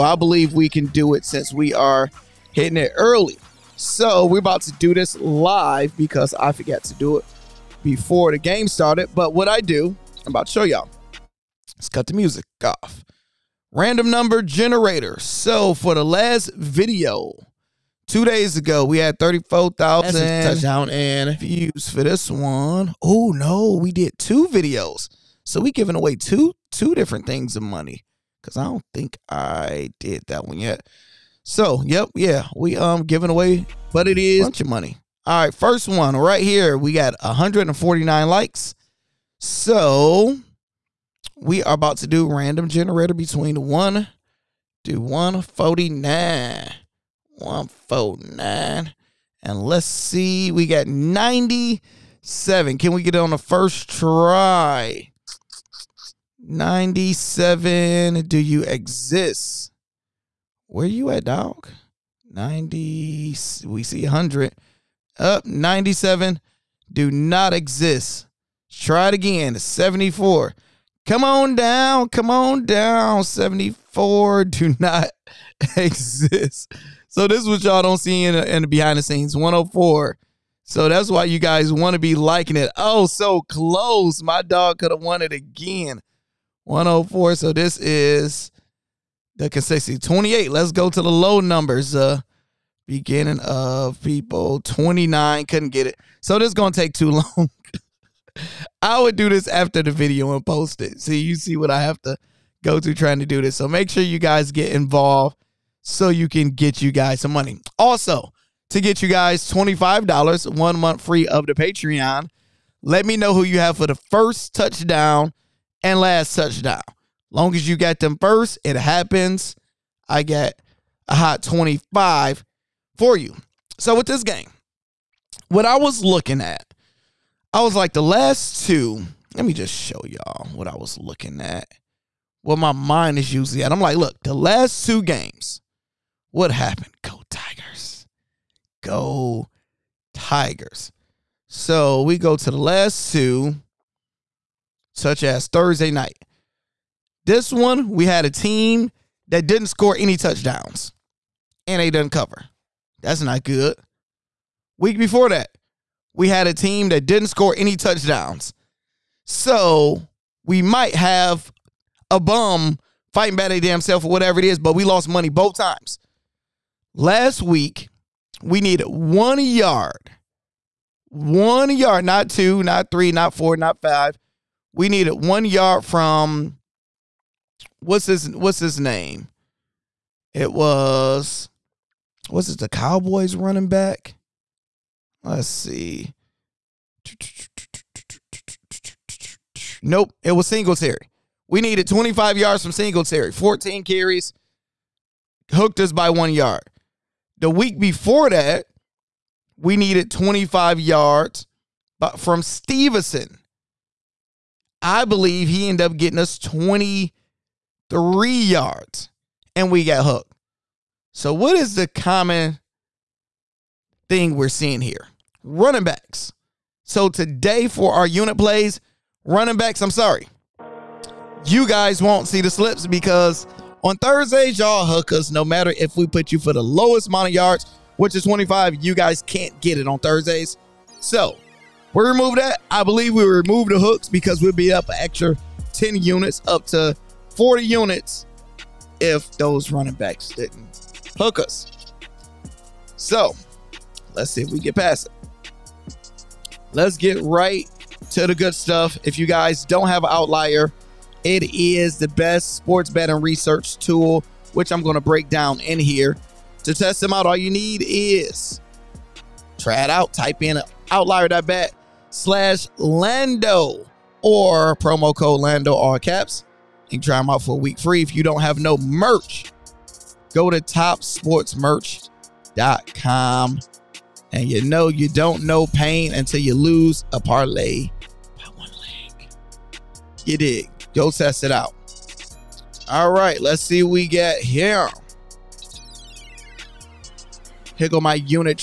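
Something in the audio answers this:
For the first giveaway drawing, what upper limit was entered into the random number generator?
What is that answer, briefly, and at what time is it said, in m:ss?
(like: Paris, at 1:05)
149, at 0:36.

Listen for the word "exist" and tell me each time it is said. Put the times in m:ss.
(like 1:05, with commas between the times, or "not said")
0:58, 1:07, 1:15.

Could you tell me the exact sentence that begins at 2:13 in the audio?
I'm like, look, the last two games, what happened?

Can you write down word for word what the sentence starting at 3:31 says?
So, what is the common thing we're seeing here?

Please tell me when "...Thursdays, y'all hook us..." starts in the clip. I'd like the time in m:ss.
3:43.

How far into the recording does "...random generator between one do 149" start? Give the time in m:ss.
0:42.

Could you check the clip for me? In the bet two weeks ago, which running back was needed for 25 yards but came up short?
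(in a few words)
Stevenson.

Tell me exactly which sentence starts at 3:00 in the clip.
It was was it the Cowboys running back?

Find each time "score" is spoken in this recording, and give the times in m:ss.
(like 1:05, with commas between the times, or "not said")
2:29, 2:37.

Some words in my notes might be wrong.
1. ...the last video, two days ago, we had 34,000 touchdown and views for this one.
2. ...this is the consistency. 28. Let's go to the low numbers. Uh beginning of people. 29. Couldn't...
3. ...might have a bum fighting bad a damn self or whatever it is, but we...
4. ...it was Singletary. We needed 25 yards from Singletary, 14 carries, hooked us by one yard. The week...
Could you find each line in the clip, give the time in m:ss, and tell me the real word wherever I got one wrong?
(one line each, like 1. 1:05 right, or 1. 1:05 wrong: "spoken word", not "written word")
1. 0:15 right
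2. 1:27 right
3. 2:40 right
4. 3:10 right.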